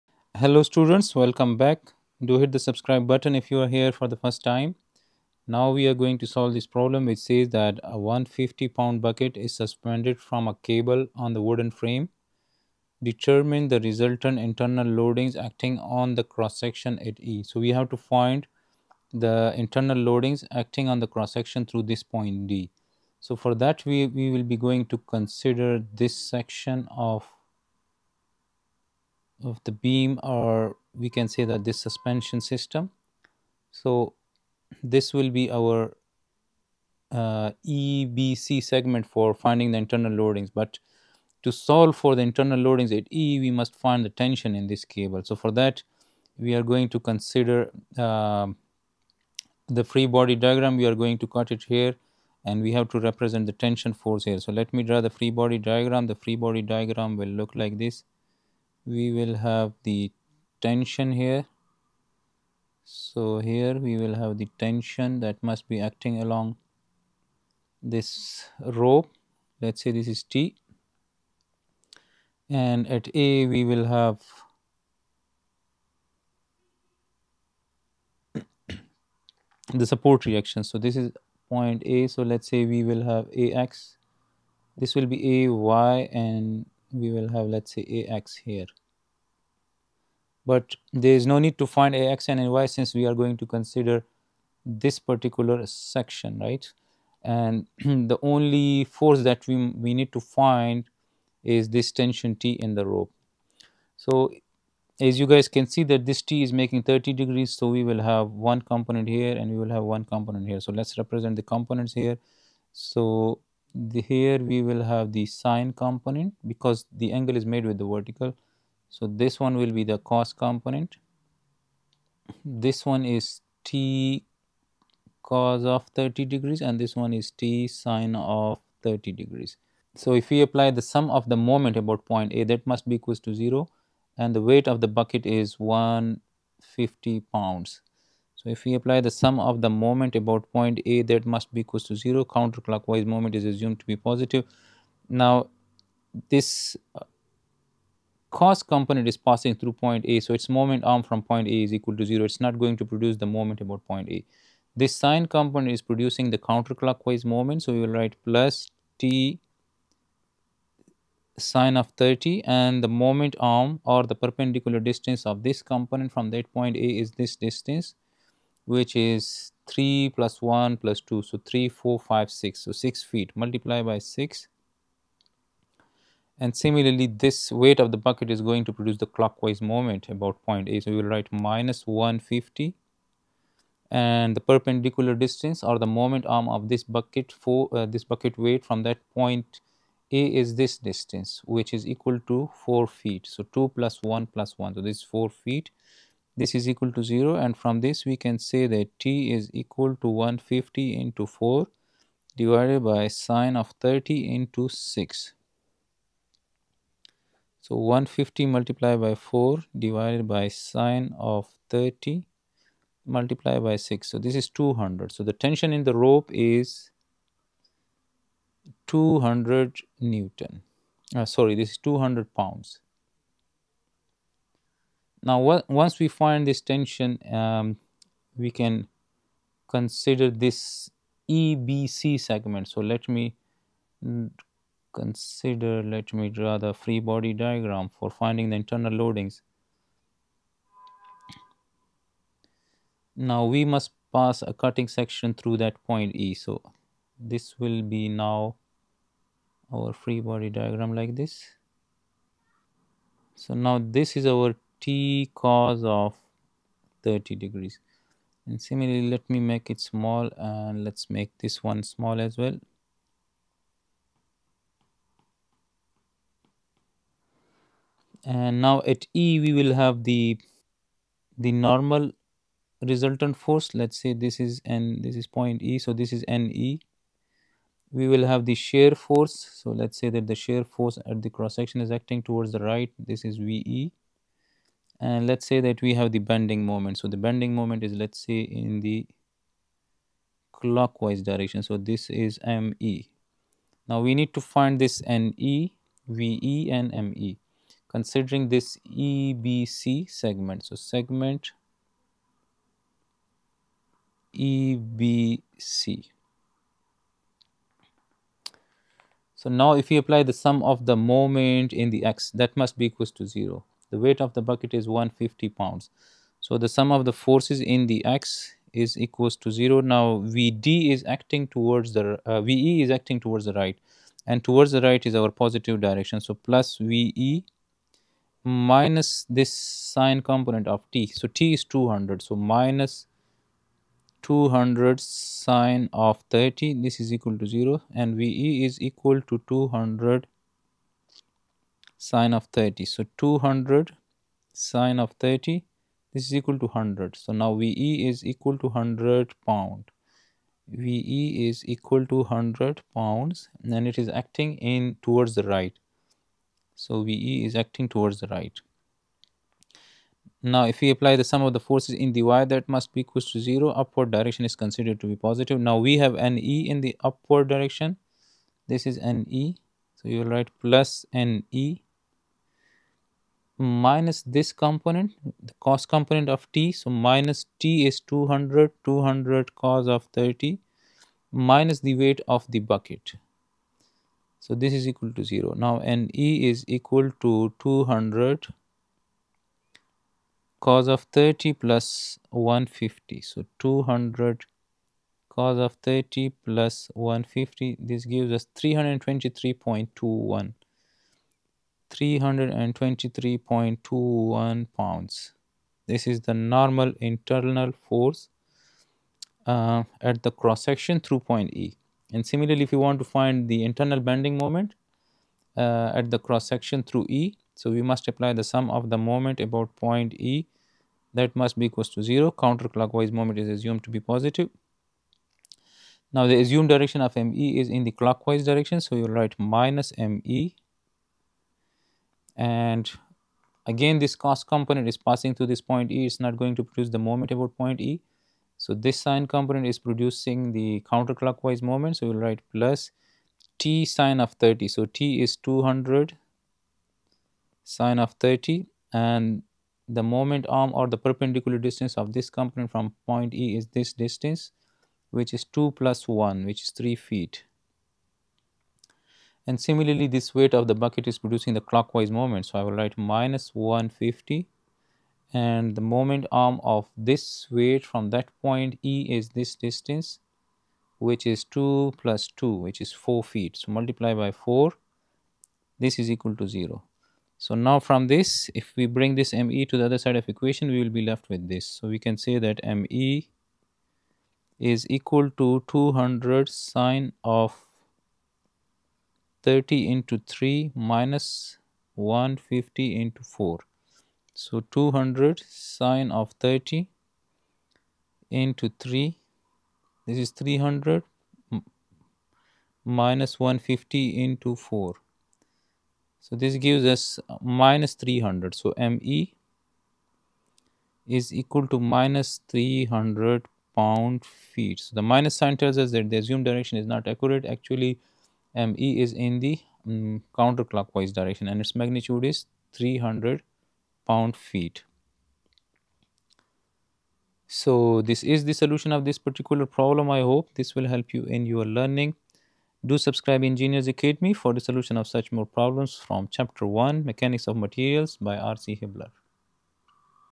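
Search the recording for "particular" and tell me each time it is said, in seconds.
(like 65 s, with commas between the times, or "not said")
94 s, 529 s.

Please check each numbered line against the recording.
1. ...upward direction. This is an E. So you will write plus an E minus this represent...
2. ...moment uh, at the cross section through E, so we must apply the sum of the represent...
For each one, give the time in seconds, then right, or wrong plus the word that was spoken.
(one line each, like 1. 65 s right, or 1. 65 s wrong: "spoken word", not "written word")
1. 367 s wrong: "component", not "represent"
2. 414 s wrong: "moment", not "represent".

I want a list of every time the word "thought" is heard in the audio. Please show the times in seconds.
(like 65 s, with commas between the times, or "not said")
not said.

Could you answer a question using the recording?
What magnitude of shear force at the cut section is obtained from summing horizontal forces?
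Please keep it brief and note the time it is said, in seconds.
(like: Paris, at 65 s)
100 pounds, at 352 s.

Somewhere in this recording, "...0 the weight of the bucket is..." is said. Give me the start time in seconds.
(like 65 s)
313 s.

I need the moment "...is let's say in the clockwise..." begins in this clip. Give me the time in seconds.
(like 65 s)
287 s.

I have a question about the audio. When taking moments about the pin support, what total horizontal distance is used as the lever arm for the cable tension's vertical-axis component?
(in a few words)
6 feet.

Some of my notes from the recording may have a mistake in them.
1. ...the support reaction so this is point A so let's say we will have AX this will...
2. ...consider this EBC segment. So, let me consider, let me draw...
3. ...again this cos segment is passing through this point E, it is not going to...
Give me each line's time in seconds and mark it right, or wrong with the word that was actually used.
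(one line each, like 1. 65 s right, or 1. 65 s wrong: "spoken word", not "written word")
1. 79 s right
2. 229 s right
3. 433 s wrong: "component", not "segment".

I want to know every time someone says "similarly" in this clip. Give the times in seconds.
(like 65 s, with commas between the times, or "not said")
176 s, 258 s, 412 s, 459 s.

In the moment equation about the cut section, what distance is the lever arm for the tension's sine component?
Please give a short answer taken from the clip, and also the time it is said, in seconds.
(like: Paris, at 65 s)
3 feet, at 456 s.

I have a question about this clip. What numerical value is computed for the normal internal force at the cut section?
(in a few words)
323.21 pounds.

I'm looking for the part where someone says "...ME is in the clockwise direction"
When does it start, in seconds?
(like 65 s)
427 s.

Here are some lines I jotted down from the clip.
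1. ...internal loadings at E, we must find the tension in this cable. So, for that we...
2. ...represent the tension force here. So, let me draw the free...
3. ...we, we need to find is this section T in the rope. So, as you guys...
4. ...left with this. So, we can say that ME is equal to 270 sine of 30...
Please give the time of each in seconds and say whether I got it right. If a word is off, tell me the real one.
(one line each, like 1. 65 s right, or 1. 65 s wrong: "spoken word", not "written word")
1. 42 s right
2. 52 s right
3. 99 s wrong: "tension", not "section"
4. 481 s wrong: "200", not "270".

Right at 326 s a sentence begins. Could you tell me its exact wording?
So, plus VE minus this sine component of t.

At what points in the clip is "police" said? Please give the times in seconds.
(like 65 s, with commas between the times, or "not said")
not said.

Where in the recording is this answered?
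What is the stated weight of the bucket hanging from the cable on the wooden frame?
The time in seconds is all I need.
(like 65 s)
7 s.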